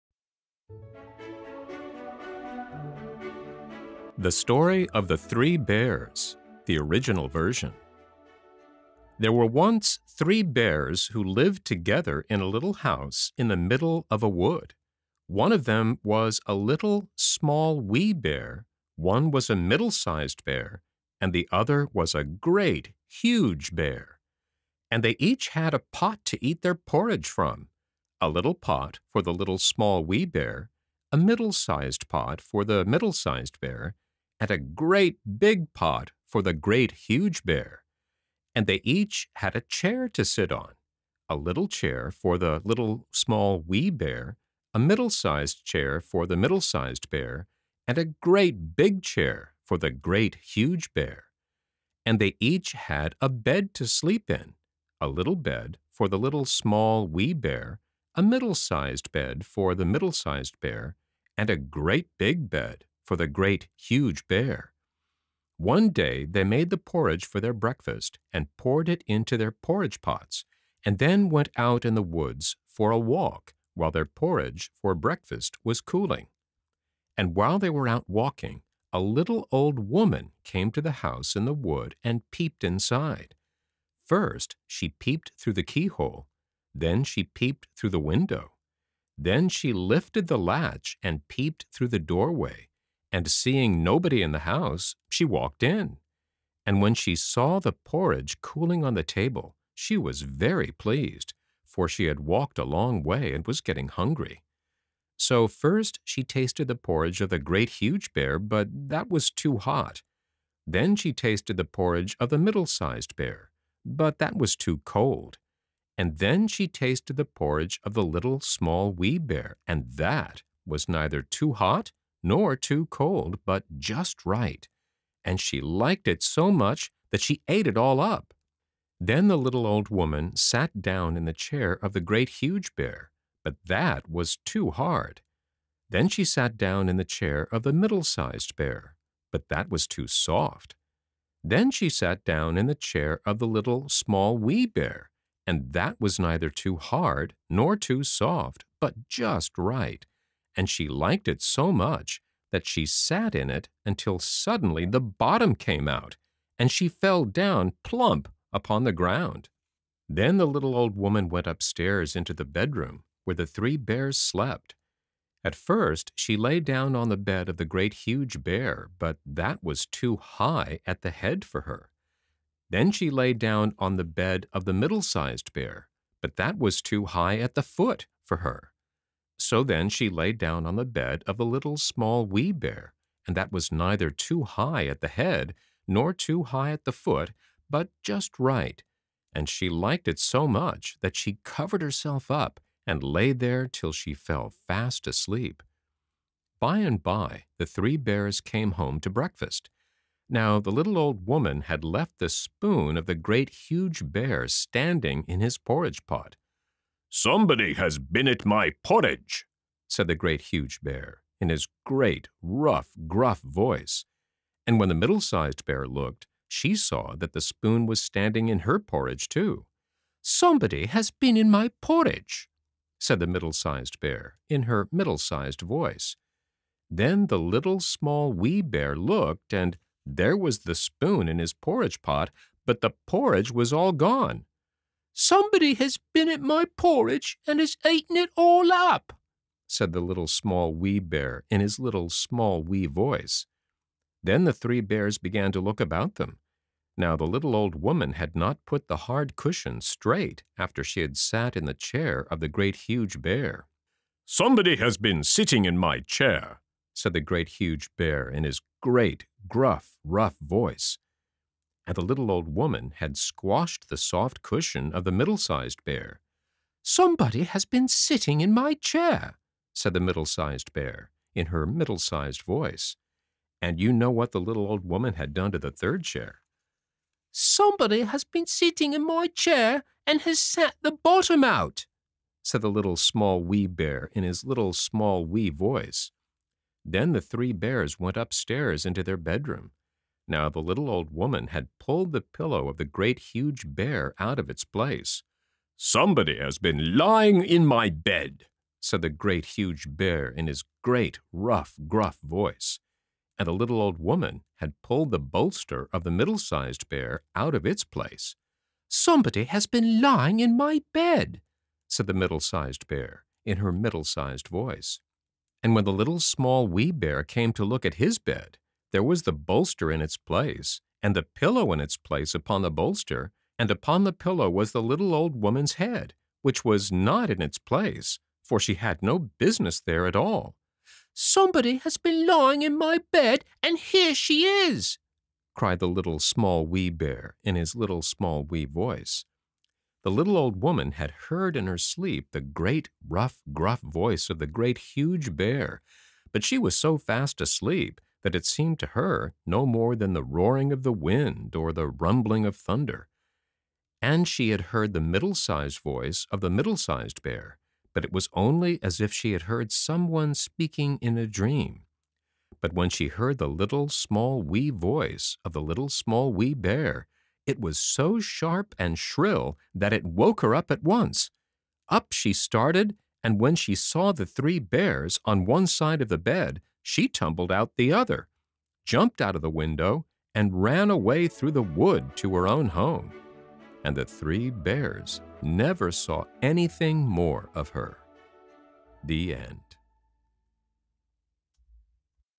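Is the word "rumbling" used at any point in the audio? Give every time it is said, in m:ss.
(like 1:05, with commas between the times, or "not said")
5:51.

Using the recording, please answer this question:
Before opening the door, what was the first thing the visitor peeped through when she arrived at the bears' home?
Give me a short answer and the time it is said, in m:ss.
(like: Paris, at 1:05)
the keyhole, at 1:25.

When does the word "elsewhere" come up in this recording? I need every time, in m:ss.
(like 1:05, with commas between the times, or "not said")
not said.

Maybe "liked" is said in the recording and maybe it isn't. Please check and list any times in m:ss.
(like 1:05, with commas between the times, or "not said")
2:05, 2:30, 3:09.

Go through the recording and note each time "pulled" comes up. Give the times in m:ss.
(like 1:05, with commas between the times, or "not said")
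4:51, 5:04.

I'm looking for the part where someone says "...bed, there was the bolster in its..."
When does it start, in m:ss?
5:18.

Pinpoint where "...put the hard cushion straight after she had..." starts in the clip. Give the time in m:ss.
4:08.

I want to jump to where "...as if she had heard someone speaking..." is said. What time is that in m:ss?
5:58.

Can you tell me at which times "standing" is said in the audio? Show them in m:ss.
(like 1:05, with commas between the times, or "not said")
3:24, 3:37.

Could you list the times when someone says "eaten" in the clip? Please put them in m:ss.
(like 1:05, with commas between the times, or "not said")
3:57.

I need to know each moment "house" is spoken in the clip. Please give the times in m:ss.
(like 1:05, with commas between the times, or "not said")
0:12, 1:21, 1:34.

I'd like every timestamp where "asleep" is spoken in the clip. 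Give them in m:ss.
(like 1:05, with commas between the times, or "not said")
3:15, 5:47.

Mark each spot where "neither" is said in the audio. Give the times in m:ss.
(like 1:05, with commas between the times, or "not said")
2:00, 2:26, 3:03.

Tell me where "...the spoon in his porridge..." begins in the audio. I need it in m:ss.
3:50.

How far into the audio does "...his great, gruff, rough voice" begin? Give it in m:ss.
4:18.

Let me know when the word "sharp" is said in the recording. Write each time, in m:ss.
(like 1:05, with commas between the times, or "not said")
6:08.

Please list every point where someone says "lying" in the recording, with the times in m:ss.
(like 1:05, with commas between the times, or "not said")
4:56, 5:10, 5:32.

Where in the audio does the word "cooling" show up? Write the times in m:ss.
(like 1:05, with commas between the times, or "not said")
1:15, 1:38.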